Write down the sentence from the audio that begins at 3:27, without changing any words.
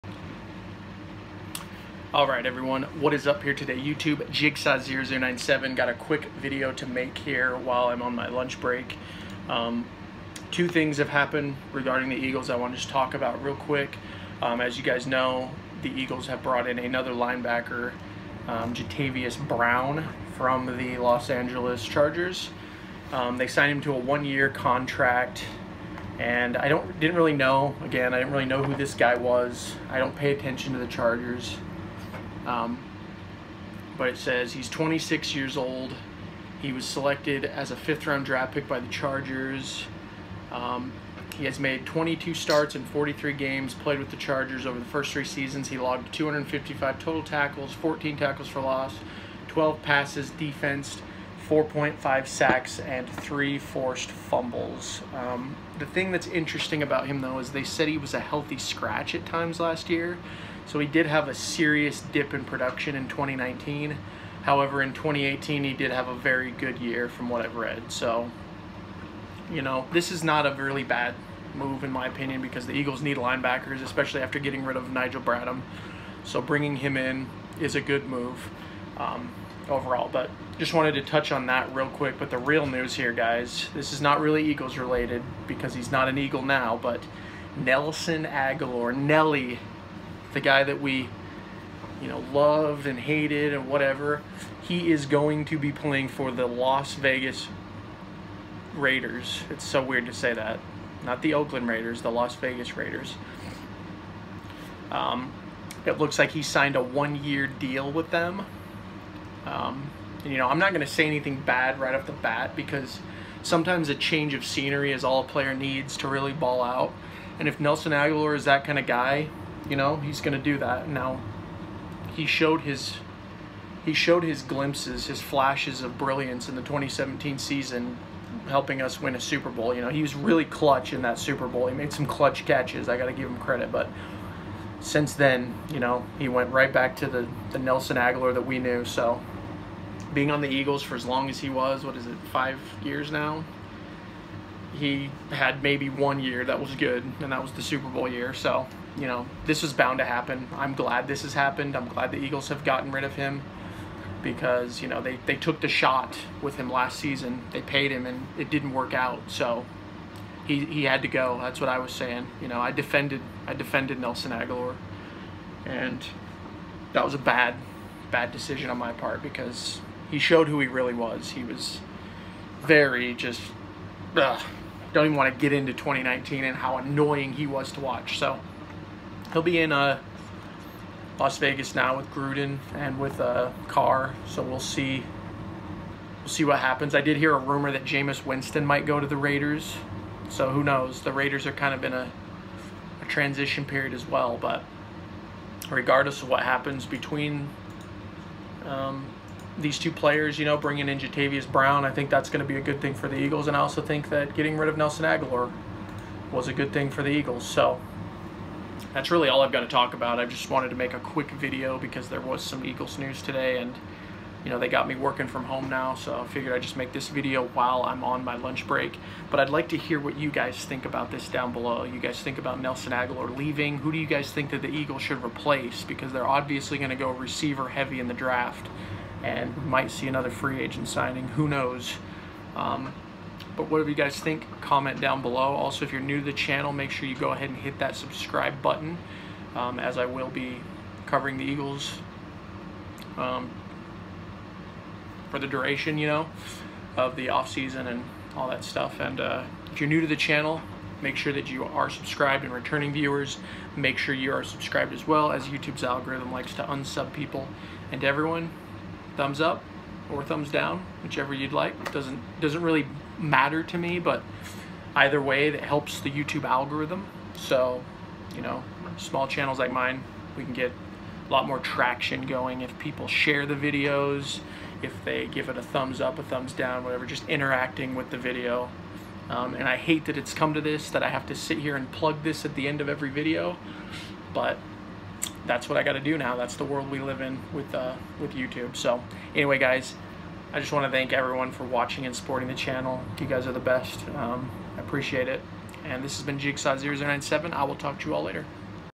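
So that's really all I've got to talk about.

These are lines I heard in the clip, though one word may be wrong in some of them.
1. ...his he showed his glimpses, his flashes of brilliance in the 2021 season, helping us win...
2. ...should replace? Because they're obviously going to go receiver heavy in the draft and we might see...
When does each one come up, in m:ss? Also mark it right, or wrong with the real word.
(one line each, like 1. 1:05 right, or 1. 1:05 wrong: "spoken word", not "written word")
1. 2:02 wrong: "2017", not "2021"
2. 3:45 right.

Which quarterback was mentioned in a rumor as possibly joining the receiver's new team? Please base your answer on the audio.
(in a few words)
Jameis Winston.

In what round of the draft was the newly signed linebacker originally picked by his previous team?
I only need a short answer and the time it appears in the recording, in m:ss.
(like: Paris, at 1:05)
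Fifth round, at 0:37.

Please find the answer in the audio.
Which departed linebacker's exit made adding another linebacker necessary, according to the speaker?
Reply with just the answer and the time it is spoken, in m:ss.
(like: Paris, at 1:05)
Nigel Bradham, at 1:14.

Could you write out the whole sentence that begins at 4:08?
And uh, if you're new to the channel, make sure that you are subscribed and returning viewers.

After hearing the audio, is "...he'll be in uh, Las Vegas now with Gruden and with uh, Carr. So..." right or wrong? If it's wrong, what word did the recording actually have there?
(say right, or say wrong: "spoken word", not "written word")
right.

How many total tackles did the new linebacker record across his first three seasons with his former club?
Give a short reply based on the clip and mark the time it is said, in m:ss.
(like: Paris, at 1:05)
255, at 0:46.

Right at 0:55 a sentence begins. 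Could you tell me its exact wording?
Um, the thing that's interesting about him, though, is they said he was a healthy scratch at times last year.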